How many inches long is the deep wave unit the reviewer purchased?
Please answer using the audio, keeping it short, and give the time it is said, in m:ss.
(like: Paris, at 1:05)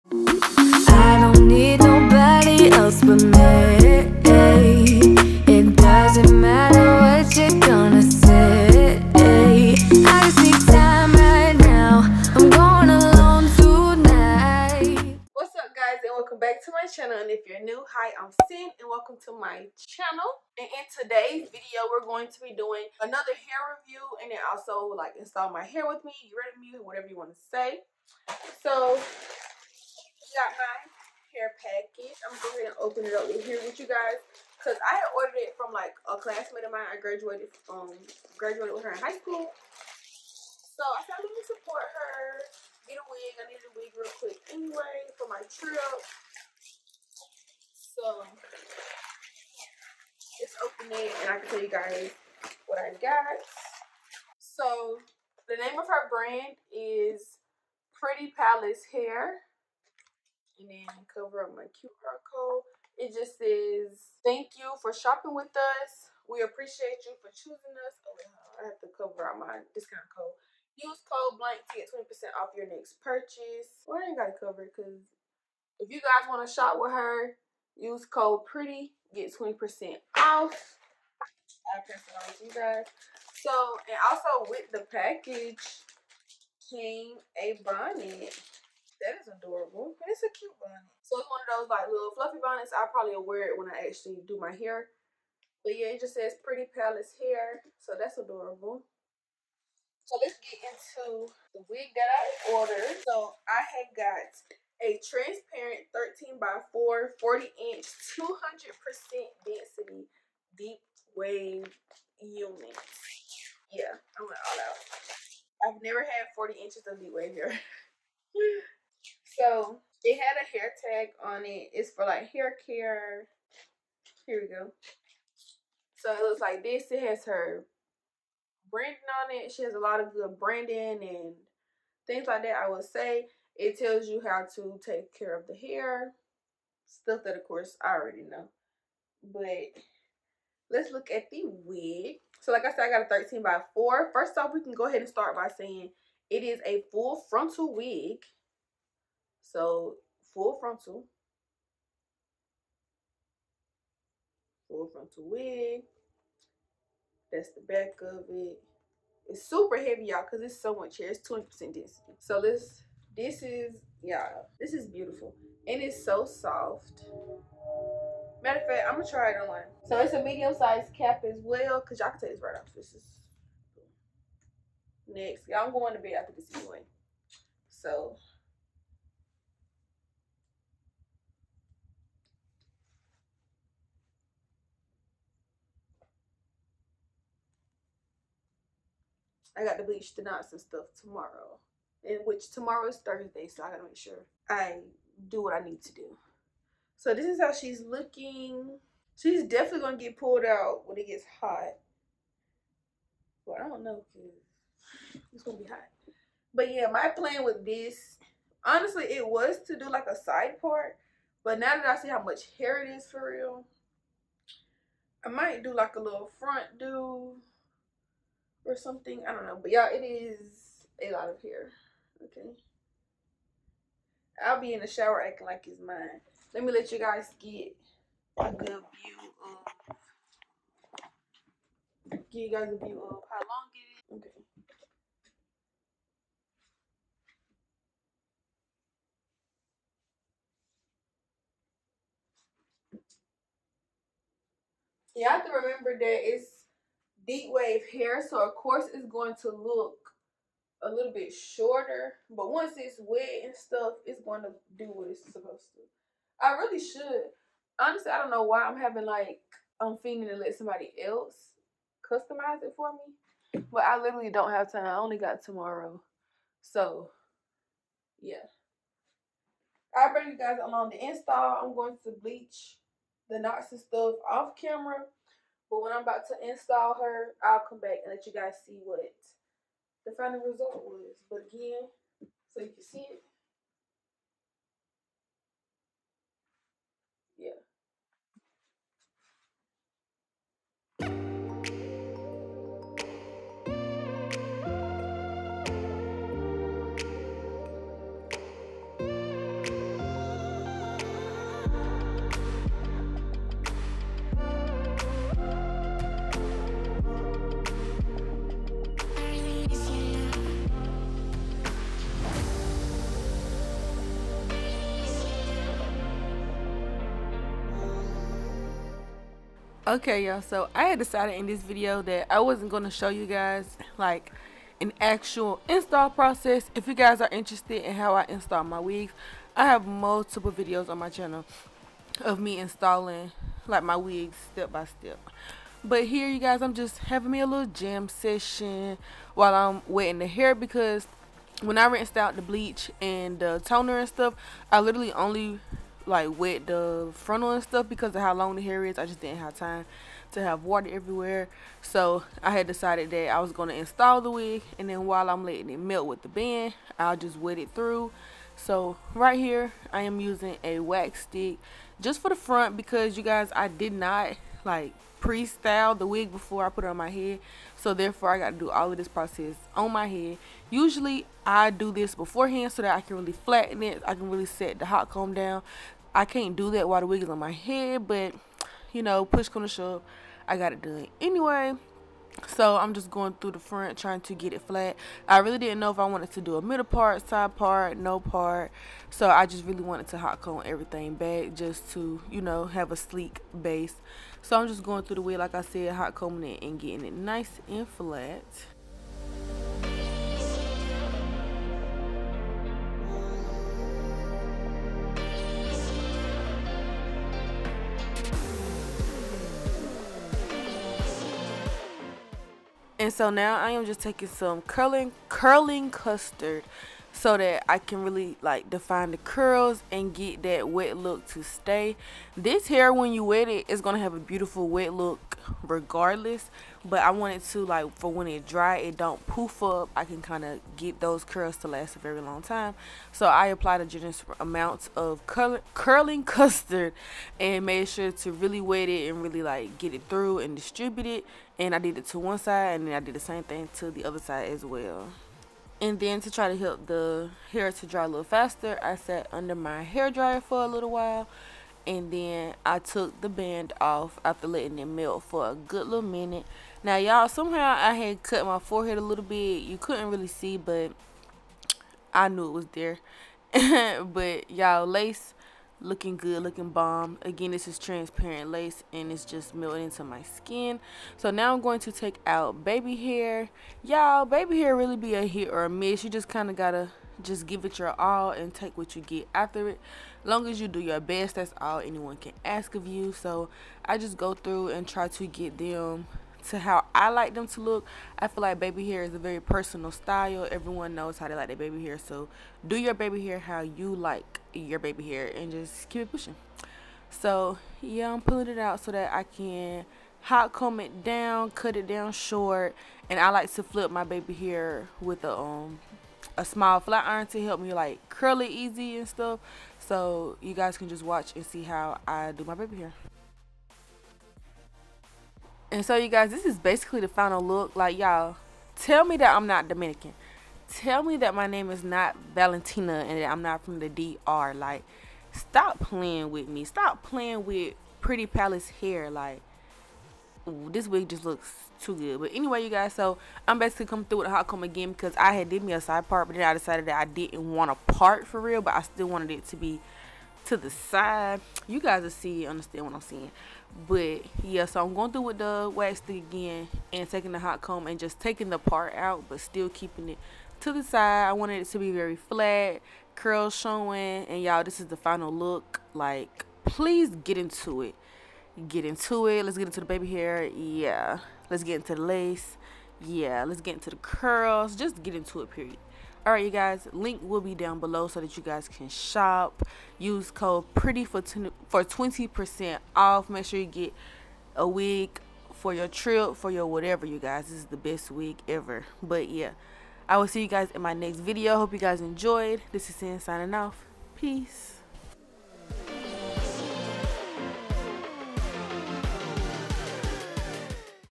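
40 inches, at 1:47.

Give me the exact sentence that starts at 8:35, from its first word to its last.
And so you guys, this is basically the final look.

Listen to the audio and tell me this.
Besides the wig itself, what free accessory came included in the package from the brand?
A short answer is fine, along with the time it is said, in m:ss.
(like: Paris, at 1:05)
A bonnet, at 1:27.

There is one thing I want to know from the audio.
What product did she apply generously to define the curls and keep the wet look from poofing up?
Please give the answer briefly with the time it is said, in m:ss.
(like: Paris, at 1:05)
Curling custard, at 6:55.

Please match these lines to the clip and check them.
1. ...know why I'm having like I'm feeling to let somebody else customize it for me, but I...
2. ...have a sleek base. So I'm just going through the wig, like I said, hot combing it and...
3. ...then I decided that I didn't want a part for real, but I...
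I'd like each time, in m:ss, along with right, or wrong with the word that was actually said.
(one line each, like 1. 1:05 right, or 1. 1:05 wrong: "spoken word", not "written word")
1. 4:18 right
2. 6:32 right
3. 8:56 right.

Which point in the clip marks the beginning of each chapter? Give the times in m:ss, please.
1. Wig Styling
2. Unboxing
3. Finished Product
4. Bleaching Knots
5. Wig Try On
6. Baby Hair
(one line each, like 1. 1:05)
1. 5:18
2. 0:50
3. 9:12
4. 4:50
5. 3:00
6. 7:44.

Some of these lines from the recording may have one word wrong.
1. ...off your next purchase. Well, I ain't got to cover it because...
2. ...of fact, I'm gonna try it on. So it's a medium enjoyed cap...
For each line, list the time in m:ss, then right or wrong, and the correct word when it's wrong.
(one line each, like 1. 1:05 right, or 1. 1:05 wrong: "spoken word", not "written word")
1. 1:12 right
2. 2:48 wrong: "sized", not "enjoyed".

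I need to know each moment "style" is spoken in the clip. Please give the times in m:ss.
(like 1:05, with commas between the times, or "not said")
6:05, 8:09.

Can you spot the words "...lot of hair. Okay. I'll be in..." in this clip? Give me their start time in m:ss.
3:41.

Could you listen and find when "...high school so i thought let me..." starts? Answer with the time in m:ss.
0:38.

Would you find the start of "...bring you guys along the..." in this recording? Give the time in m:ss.
4:30.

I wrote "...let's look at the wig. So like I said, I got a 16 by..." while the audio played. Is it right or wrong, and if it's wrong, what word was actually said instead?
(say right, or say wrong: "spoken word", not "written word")
wrong: "13", not "16".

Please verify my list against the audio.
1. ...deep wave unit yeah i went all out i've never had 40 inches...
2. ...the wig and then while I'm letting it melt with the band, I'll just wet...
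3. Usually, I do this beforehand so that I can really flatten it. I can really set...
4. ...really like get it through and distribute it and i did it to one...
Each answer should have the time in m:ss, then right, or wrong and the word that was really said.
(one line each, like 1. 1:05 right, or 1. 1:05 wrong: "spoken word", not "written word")
1. 1:50 right
2. 5:54 right
3. 6:10 right
4. 7:19 right.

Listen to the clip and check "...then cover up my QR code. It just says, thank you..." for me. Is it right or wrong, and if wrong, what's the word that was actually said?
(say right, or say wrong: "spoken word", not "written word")
right.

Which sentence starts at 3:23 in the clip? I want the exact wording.
Well, I don't know, it's gonna be hot.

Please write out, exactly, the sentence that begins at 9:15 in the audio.
Like, please get into it get into it.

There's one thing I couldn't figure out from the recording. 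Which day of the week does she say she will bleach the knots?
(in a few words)
Thursday.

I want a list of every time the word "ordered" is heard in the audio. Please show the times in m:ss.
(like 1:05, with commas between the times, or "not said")
0:35, 1:42.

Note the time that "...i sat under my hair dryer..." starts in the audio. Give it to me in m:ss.
7:28.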